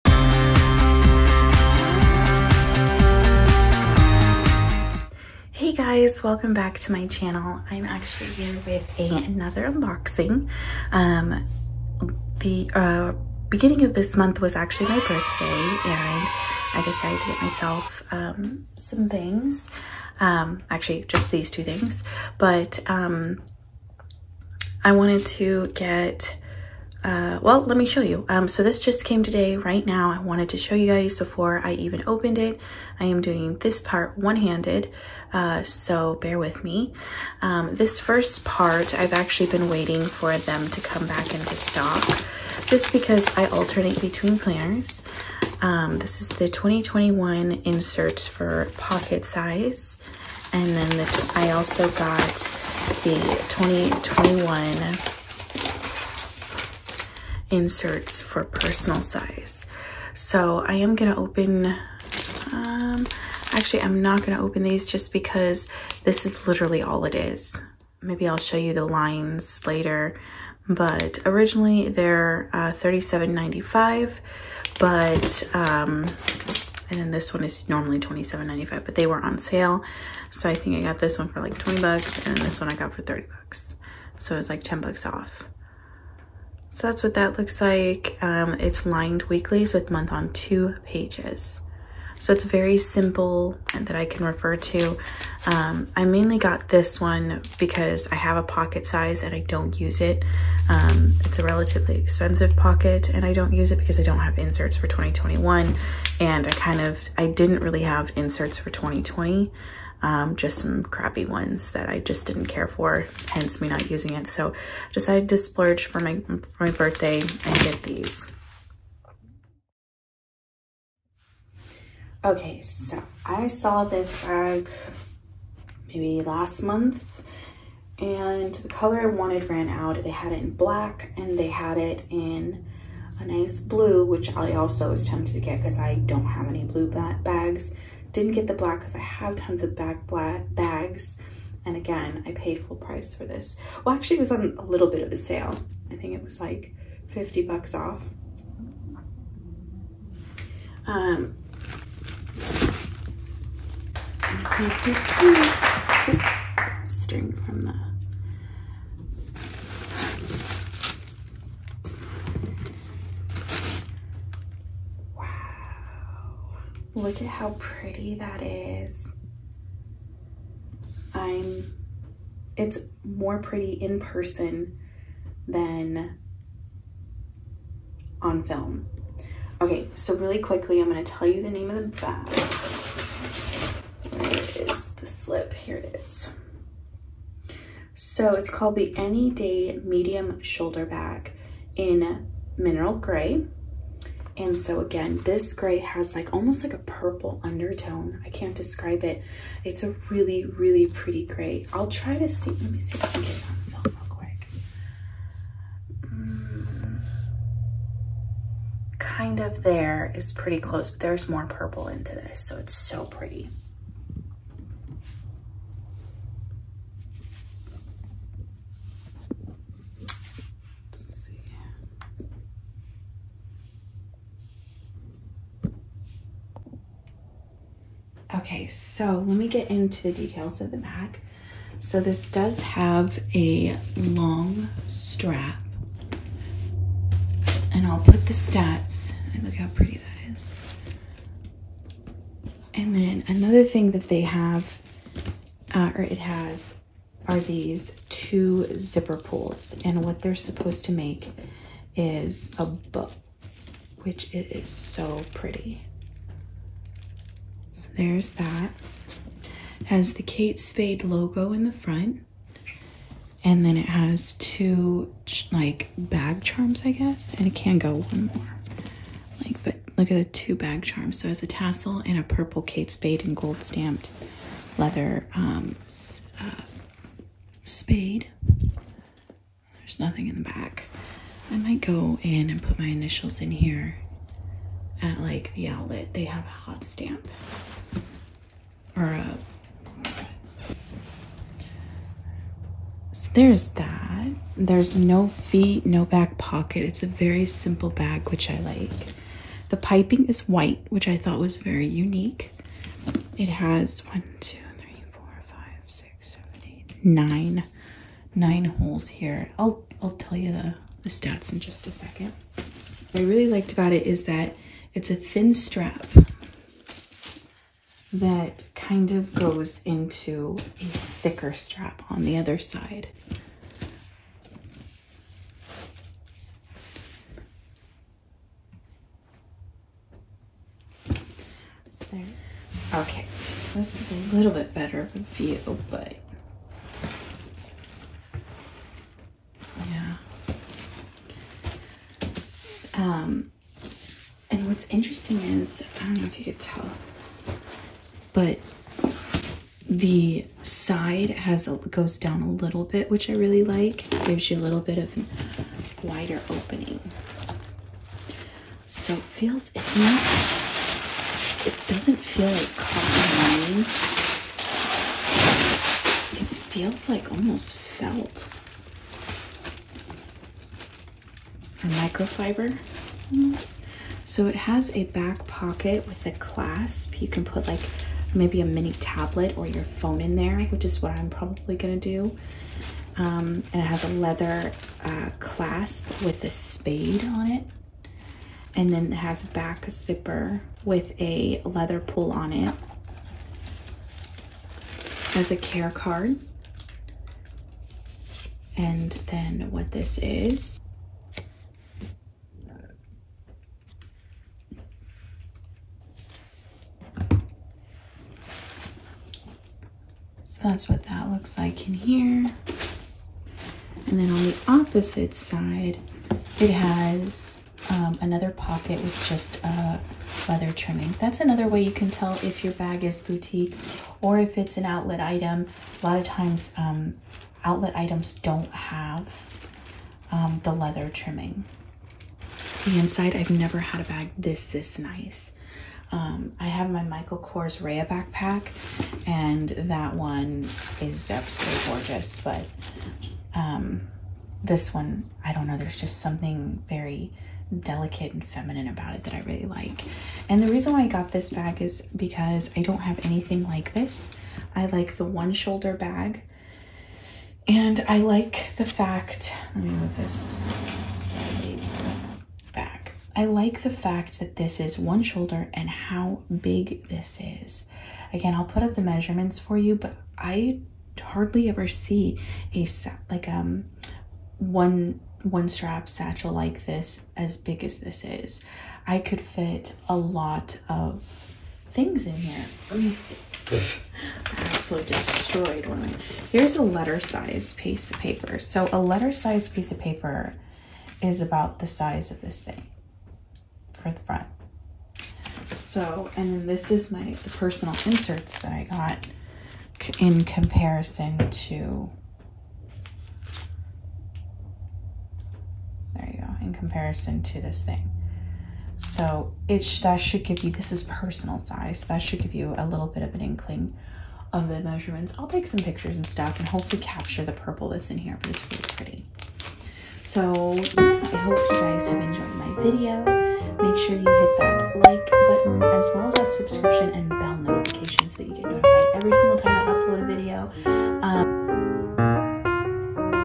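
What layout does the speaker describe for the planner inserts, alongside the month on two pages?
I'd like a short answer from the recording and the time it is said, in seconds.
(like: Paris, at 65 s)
Lined weekly, at 88 s.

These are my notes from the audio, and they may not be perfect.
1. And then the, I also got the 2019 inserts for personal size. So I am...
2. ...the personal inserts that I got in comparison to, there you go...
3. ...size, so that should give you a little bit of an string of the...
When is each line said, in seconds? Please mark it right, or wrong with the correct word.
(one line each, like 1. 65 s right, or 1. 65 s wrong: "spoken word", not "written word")
1. 50 s wrong: "2021", not "2019"
2. 497 s right
3. 511 s wrong: "inkling", not "string".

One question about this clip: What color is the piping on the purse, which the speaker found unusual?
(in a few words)
White.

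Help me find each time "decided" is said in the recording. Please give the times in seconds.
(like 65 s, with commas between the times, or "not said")
16 s, 114 s.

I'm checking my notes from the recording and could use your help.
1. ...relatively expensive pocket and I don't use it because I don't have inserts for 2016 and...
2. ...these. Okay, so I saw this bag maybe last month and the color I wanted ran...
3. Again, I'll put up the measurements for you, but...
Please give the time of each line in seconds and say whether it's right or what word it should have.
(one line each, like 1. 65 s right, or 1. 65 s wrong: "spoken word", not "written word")
1. 101 s wrong: "2021", not "2016"
2. 117 s right
3. 468 s right.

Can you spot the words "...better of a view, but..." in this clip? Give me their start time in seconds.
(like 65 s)
334 s.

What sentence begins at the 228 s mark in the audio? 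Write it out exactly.
Okay, so let me get into the details of the bag.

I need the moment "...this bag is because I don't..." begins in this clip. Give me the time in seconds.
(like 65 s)
451 s.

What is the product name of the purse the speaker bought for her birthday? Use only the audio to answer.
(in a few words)
Anyday Medium Shoulder Bag.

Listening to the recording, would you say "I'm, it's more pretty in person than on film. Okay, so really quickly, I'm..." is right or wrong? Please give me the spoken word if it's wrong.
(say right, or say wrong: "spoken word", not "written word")
right.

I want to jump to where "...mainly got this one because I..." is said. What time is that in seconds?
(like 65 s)
96 s.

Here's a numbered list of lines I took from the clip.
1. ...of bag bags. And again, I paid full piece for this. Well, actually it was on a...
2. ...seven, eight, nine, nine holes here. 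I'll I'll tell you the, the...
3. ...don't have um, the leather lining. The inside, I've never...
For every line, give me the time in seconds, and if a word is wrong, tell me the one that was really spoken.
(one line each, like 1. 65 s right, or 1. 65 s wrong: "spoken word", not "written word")
1. 139 s wrong: "price", not "piece"
2. 306 s right
3. 428 s wrong: "trimming", not "lining".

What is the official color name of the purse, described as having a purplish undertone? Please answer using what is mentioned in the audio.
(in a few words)
Mineral gray.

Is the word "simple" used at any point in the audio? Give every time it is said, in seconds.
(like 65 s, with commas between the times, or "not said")
92 s, 297 s.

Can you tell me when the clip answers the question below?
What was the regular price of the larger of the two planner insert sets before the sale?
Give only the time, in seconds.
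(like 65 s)
72 s.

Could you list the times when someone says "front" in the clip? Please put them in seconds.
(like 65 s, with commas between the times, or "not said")
261 s, 494 s.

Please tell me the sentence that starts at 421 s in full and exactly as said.
That's another way you can tell if your bag is boutique or if it's an outlet item.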